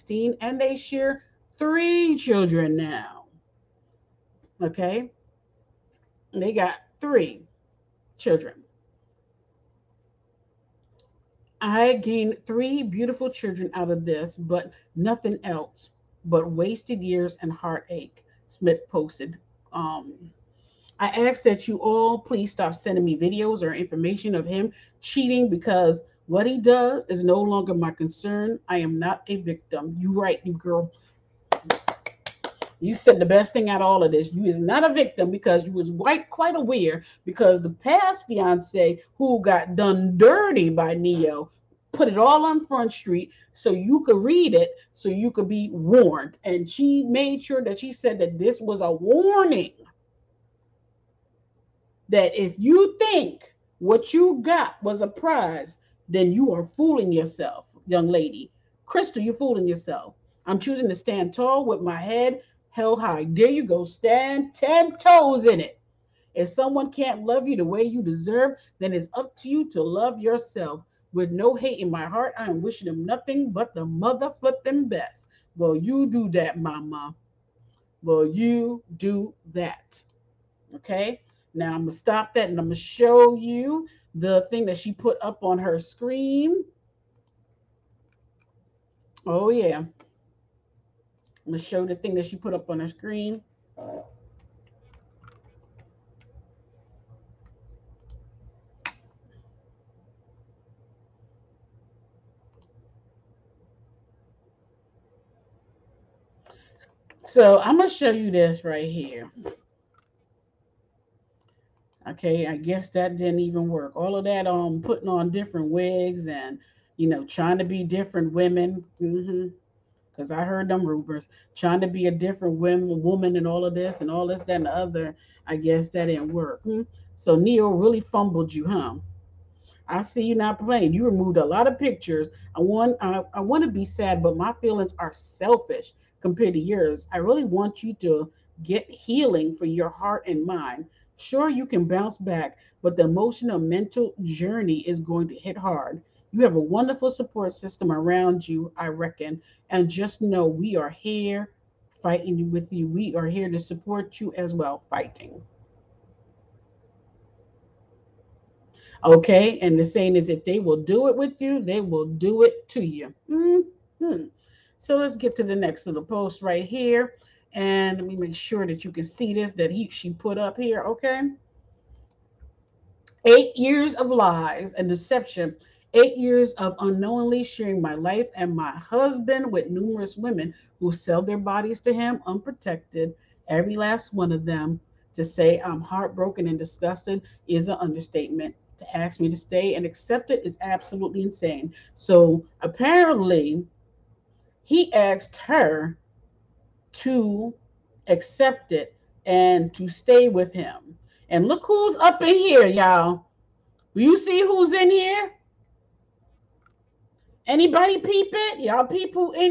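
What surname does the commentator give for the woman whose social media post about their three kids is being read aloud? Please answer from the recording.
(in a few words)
Smith.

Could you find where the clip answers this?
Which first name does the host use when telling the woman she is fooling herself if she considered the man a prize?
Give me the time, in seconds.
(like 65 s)
58 s.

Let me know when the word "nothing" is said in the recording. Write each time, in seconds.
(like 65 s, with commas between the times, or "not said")
14 s, 73 s.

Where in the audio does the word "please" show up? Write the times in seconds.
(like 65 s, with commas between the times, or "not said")
22 s.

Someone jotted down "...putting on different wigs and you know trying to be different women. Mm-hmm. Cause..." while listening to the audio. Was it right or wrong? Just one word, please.
right.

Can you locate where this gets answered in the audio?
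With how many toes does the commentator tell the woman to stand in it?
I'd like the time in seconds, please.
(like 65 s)
64 s.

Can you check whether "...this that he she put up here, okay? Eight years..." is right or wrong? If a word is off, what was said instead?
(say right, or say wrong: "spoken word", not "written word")
right.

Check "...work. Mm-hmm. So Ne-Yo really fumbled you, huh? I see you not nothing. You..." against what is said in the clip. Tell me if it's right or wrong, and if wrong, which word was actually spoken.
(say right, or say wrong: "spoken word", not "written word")
wrong: "playing", not "nothing".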